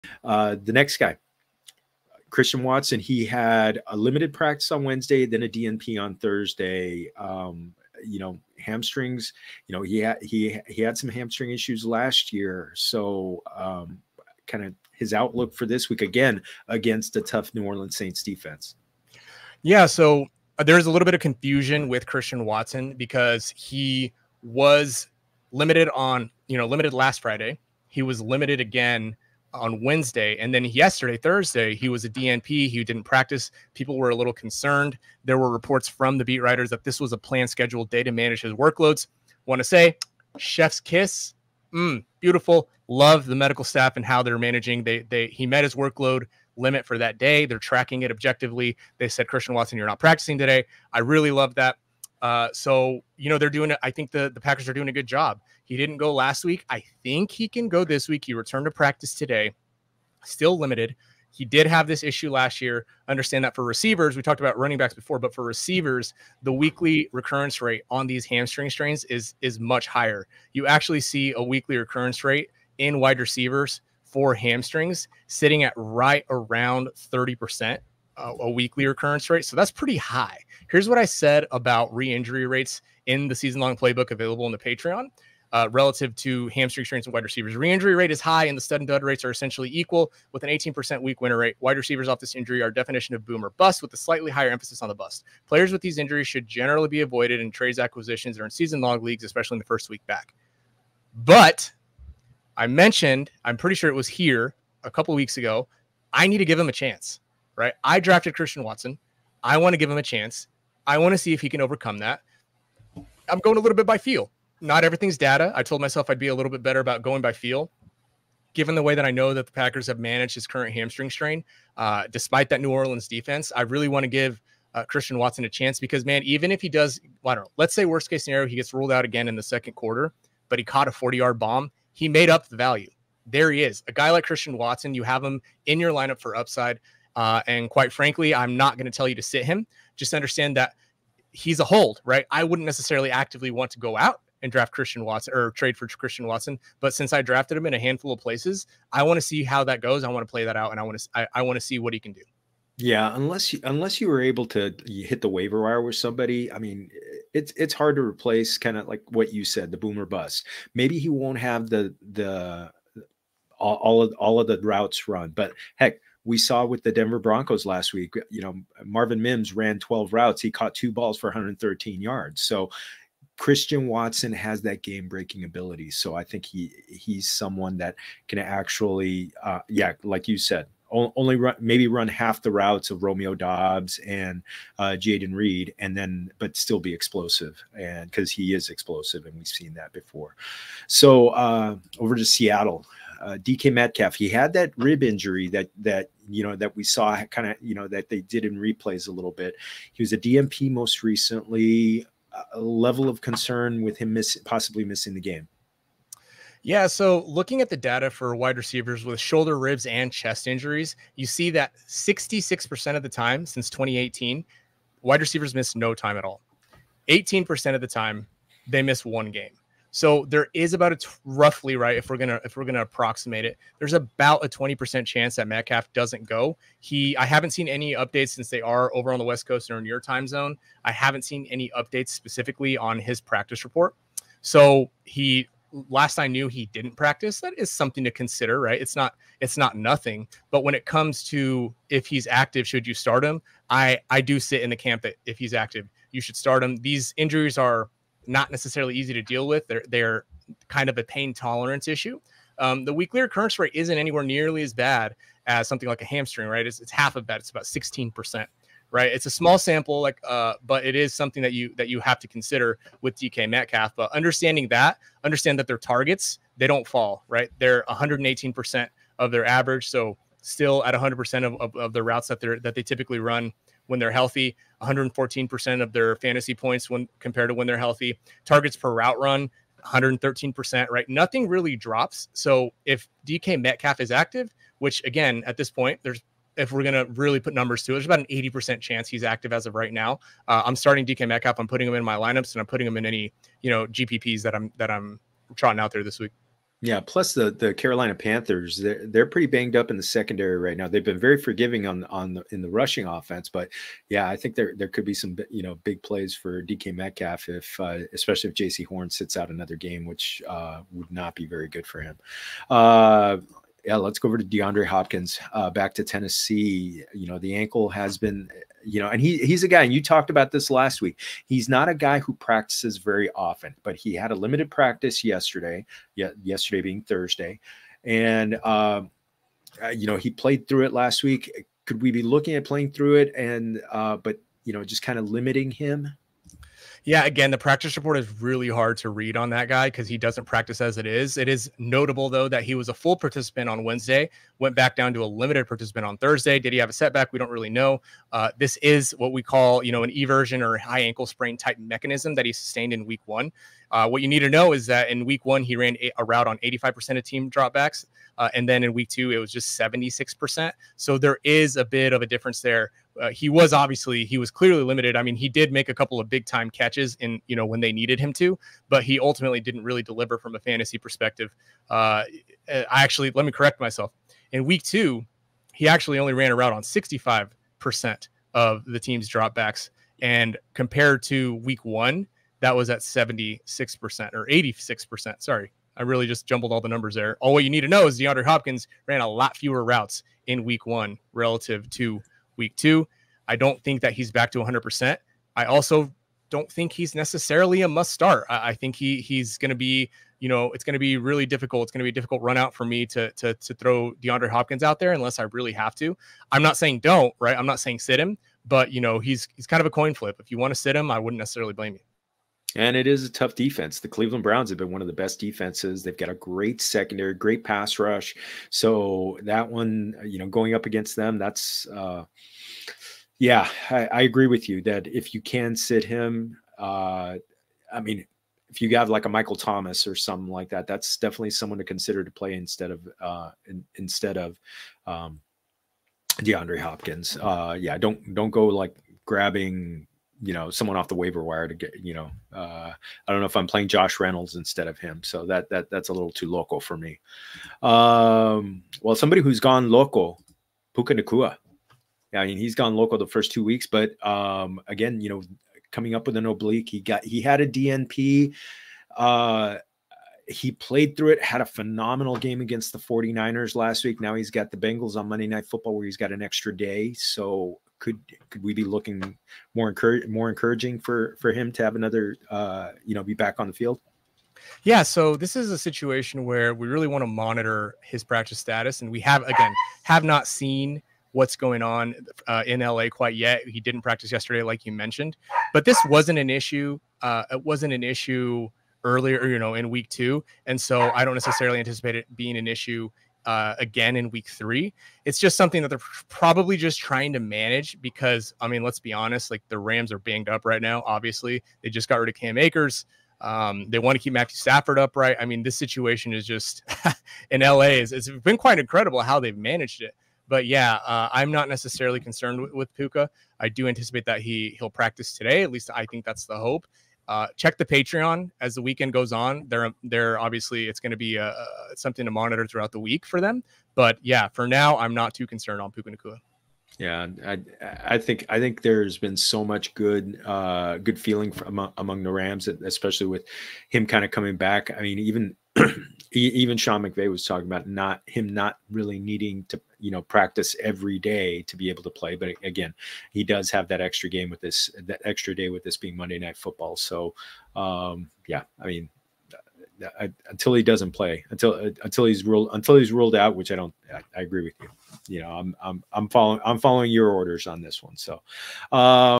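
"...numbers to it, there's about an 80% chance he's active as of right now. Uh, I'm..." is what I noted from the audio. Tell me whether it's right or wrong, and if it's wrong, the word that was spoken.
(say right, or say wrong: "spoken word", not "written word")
right.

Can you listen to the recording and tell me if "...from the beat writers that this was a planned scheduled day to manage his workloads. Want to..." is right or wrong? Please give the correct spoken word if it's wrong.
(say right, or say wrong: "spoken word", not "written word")
right.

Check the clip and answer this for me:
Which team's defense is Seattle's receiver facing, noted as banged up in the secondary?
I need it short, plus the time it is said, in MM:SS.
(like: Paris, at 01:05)
Carolina Panthers, at 04:57.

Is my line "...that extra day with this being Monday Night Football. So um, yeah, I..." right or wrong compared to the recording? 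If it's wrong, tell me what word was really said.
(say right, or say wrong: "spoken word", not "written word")
right.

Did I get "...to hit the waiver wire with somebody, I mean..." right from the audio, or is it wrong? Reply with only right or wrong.
right.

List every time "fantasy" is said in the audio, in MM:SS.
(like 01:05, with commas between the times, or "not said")
04:36, 06:10.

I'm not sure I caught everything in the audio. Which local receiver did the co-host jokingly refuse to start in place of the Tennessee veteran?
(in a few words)
Josh Reynolds.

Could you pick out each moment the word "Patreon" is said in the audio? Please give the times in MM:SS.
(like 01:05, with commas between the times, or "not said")
01:24, 08:37.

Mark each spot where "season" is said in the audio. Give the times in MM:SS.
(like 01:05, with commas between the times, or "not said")
01:23, 01:38.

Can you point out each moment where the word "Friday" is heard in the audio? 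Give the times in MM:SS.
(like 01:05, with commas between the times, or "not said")
00:27.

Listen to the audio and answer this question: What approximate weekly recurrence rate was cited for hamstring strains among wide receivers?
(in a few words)
30%.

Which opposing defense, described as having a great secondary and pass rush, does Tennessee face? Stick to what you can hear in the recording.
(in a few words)
Cleveland Browns.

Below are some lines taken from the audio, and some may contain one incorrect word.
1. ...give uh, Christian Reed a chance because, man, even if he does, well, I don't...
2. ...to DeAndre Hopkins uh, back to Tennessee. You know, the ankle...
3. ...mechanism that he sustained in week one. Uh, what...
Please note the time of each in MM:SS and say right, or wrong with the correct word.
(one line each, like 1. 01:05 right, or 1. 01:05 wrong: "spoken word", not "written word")
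1. 02:04 wrong: "Watson", not "Reed"
2. 05:14 right
3. 05:51 right.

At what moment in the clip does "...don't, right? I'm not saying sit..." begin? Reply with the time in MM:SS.
06:46.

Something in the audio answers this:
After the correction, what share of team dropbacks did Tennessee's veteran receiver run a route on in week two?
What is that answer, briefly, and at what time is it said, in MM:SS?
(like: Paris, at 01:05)
65%, at 06:16.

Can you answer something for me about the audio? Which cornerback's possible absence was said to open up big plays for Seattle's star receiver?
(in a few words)
Jaycee Horn.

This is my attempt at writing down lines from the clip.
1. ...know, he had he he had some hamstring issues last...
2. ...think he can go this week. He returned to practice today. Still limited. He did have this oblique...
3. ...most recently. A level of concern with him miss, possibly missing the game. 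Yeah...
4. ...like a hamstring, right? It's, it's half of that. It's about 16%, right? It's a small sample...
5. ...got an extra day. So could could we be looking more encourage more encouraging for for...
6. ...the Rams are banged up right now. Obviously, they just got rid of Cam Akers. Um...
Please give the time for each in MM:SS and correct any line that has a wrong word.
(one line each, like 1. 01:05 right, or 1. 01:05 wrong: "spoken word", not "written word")
1. 00:09 right
2. 00:57 wrong: "issue", not "oblique"
3. 03:20 right
4. 04:15 right
5. 07:46 right
6. 08:19 right.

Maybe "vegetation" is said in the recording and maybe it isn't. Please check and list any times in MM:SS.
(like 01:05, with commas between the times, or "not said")
not said.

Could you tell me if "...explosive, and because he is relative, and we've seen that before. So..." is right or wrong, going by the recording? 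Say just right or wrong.
wrong.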